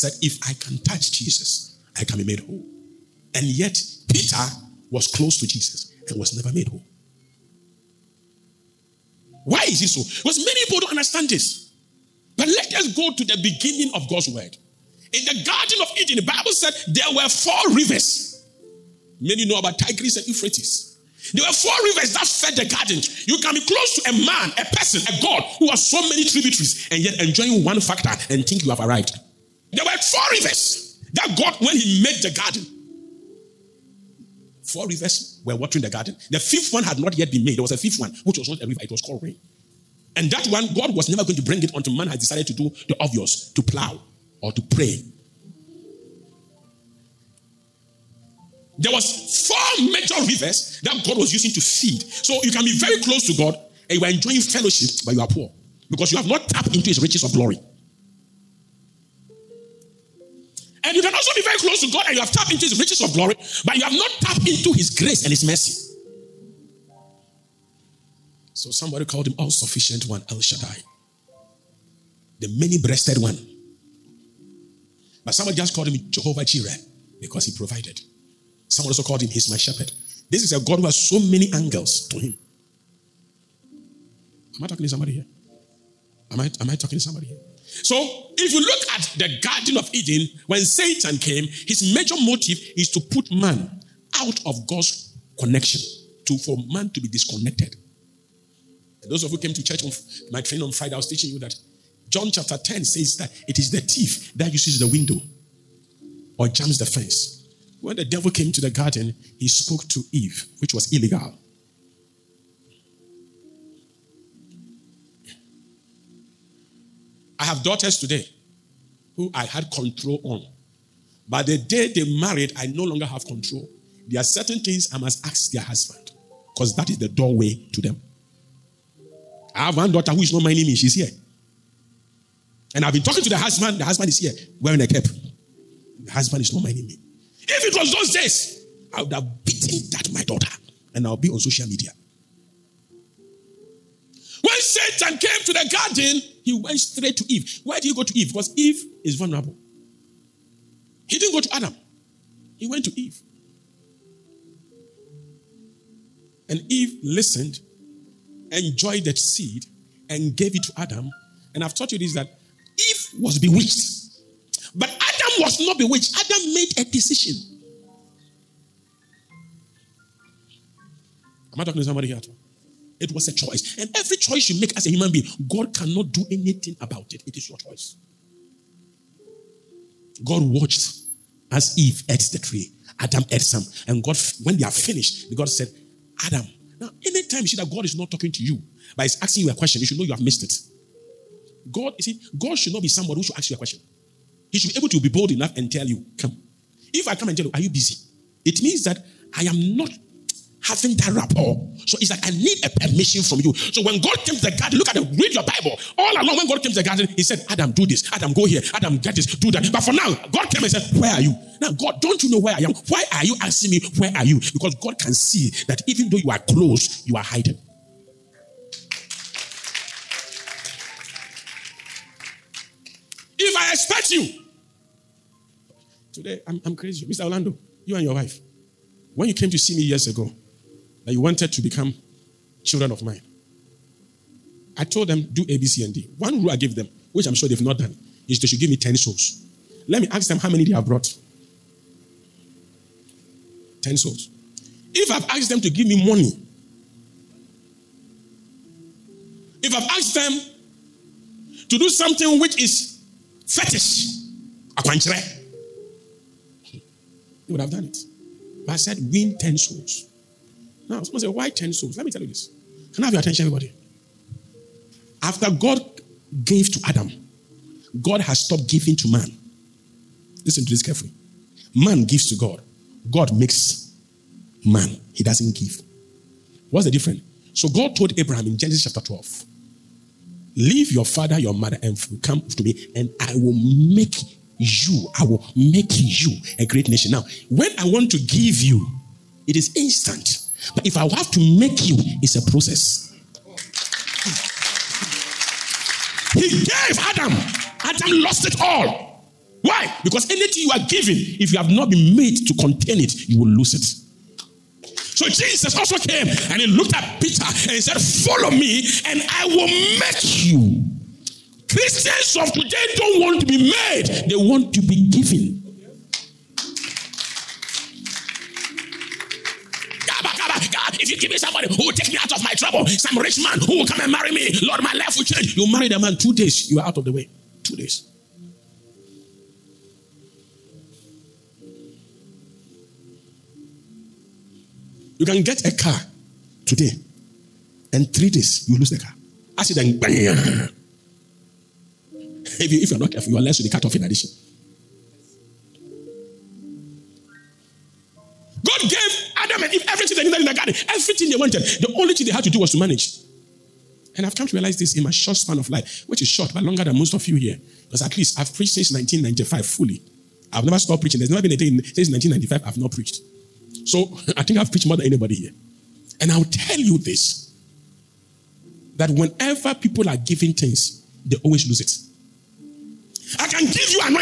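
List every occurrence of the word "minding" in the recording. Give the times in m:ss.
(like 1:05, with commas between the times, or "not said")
2:10, 2:16.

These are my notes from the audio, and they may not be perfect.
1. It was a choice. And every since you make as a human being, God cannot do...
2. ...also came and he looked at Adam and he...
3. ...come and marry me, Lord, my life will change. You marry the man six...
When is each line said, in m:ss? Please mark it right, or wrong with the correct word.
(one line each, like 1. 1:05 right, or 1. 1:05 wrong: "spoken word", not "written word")
1. 2:53 wrong: "choice", not "since"
2. 5:05 wrong: "Peter", not "Adam"
3. 5:23 wrong: "two", not "six".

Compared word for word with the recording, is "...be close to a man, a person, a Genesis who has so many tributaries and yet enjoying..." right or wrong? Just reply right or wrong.
wrong.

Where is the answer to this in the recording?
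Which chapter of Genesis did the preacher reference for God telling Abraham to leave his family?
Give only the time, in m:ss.
4:38.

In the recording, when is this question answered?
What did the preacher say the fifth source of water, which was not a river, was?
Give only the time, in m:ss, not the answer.
0:39.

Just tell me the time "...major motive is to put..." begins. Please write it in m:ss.
1:31.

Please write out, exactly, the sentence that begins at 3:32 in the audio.
Why are you asking me, Where are you?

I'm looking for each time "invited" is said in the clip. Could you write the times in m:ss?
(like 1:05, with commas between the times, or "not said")
not said.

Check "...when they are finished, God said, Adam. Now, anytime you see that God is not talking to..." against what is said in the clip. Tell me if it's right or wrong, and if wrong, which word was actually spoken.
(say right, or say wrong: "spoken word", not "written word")
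right.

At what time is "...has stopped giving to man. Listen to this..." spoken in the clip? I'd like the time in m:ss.
4:28.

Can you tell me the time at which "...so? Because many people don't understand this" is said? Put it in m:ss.
0:09.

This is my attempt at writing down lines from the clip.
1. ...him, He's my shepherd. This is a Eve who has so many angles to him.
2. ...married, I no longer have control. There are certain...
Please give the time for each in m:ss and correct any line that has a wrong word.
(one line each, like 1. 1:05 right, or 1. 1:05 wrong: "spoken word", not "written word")
1. 1:19 wrong: "God", not "Eve"
2. 2:02 right.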